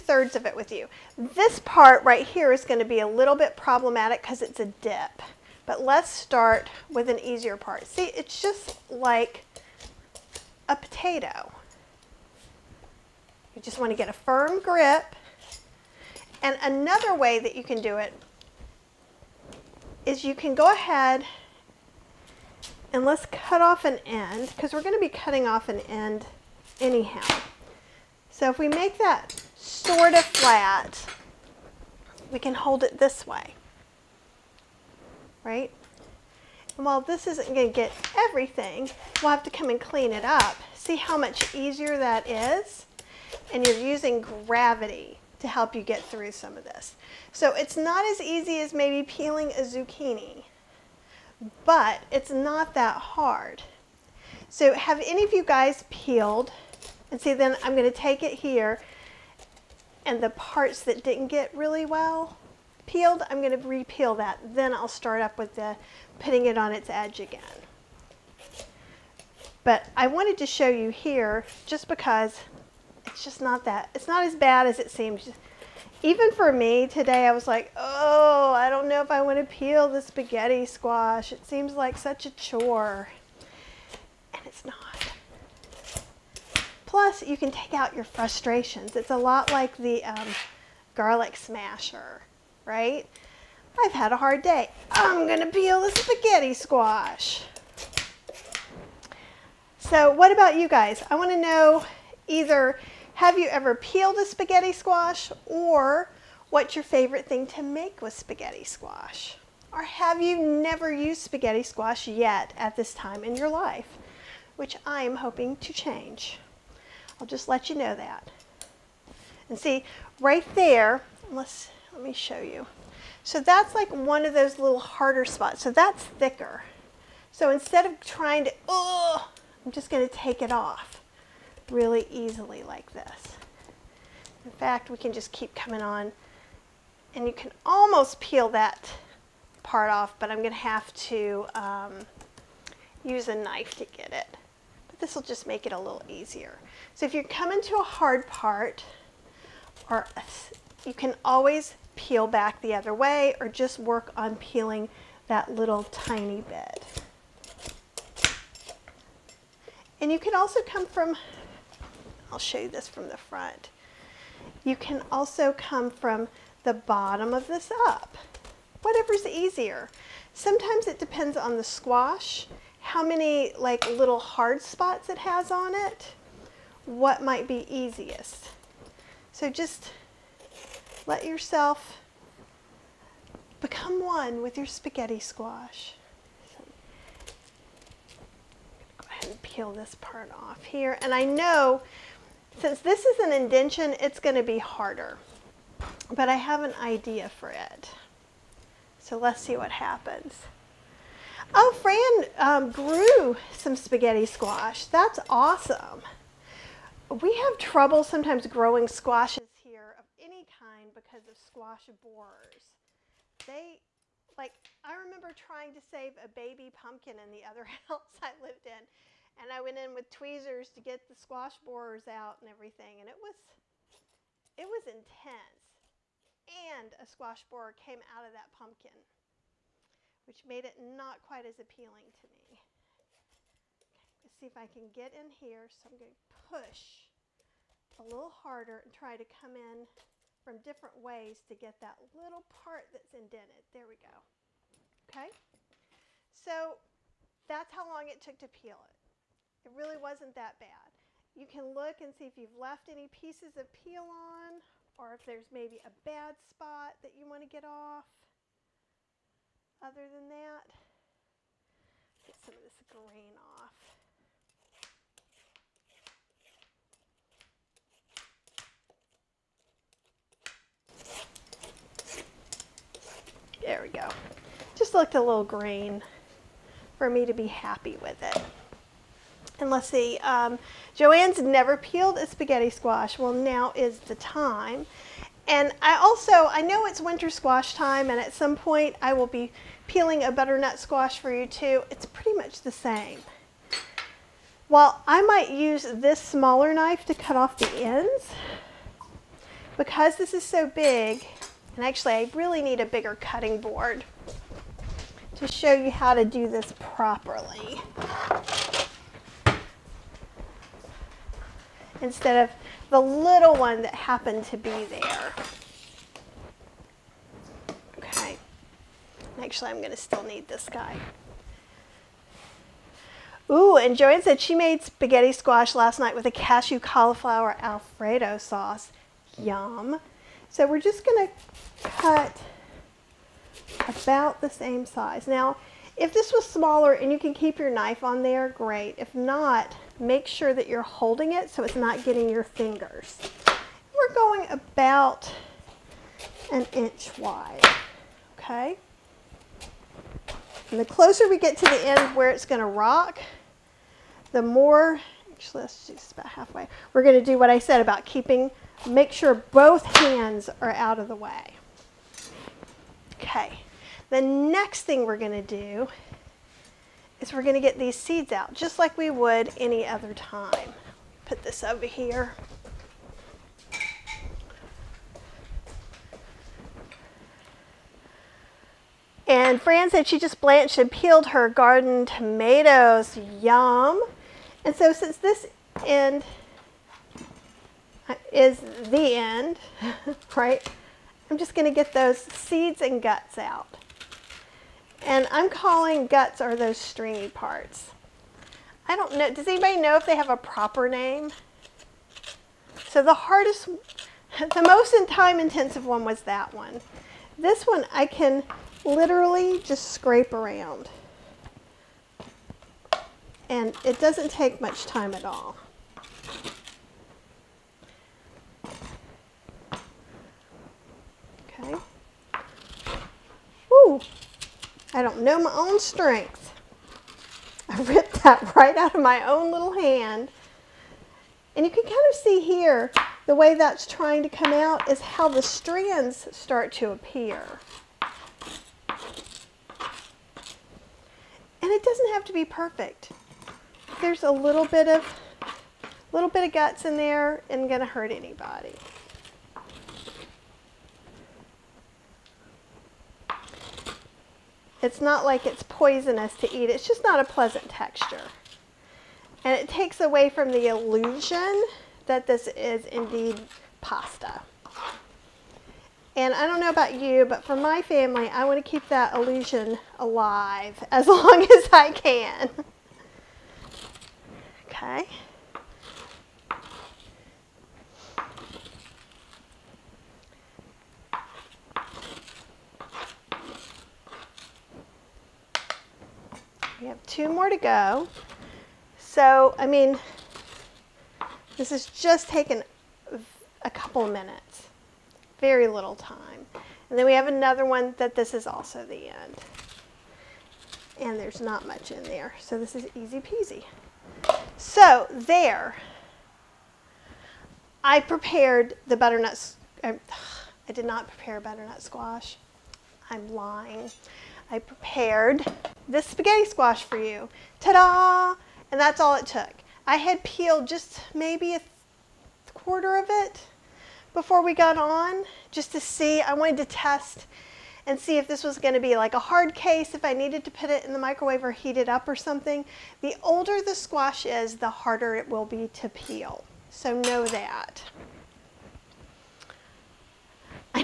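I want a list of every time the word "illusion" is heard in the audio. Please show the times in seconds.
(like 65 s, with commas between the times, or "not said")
460 s, 469 s.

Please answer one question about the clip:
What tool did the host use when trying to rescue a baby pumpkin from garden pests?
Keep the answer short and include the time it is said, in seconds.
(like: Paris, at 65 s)
tweezers, at 220 s.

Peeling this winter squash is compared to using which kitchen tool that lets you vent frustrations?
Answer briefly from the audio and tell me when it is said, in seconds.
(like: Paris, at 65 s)
garlic smasher, at 90 s.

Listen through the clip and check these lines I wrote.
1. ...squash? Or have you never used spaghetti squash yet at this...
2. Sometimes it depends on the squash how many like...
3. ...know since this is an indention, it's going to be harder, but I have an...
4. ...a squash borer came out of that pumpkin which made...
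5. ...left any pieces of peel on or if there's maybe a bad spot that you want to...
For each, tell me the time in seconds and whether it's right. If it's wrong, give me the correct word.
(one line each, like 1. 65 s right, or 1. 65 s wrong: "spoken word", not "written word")
1. 108 s right
2. 170 s right
3. 191 s right
4. 226 s right
5. 252 s right.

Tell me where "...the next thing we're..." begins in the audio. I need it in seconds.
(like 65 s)
364 s.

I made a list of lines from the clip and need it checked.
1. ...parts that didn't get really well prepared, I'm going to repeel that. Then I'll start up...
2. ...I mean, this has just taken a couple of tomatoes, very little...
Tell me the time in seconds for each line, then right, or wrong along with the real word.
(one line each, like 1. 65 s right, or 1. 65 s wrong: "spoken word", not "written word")
1. 60 s wrong: "peeled", not "prepared"
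2. 489 s wrong: "minutes", not "tomatoes".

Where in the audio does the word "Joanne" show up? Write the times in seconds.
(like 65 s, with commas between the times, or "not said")
280 s, 323 s.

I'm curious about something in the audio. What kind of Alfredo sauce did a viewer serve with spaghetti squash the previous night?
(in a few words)
cashew cauliflower Alfredo.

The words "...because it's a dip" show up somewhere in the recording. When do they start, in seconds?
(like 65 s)
4 s.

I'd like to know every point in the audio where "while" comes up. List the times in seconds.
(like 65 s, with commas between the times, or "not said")
36 s, 294 s.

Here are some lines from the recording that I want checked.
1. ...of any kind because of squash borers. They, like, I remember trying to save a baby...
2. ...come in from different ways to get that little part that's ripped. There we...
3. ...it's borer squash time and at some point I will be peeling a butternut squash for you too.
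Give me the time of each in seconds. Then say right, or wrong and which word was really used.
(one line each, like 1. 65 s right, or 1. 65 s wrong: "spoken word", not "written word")
1. 209 s right
2. 239 s wrong: "indented", not "ripped"
3. 286 s wrong: "winter", not "borer".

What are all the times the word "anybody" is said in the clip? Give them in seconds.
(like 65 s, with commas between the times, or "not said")
399 s, 448 s.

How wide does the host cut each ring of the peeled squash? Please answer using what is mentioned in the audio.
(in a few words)
about 1 inch.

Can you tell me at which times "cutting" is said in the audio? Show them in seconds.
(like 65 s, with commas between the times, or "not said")
25 s, 303 s.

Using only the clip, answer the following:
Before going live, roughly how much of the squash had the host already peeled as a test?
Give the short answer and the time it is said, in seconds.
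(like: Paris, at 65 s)
a quarter, at 521 s.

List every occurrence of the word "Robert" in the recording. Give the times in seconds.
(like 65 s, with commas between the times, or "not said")
not said.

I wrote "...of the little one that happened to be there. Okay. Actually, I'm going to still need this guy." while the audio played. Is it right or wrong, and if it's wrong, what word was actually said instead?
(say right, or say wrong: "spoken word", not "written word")
right.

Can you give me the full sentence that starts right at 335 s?
Now, if this was smaller and you can keep your knife on there, great.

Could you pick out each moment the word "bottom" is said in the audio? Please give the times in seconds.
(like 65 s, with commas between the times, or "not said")
166 s.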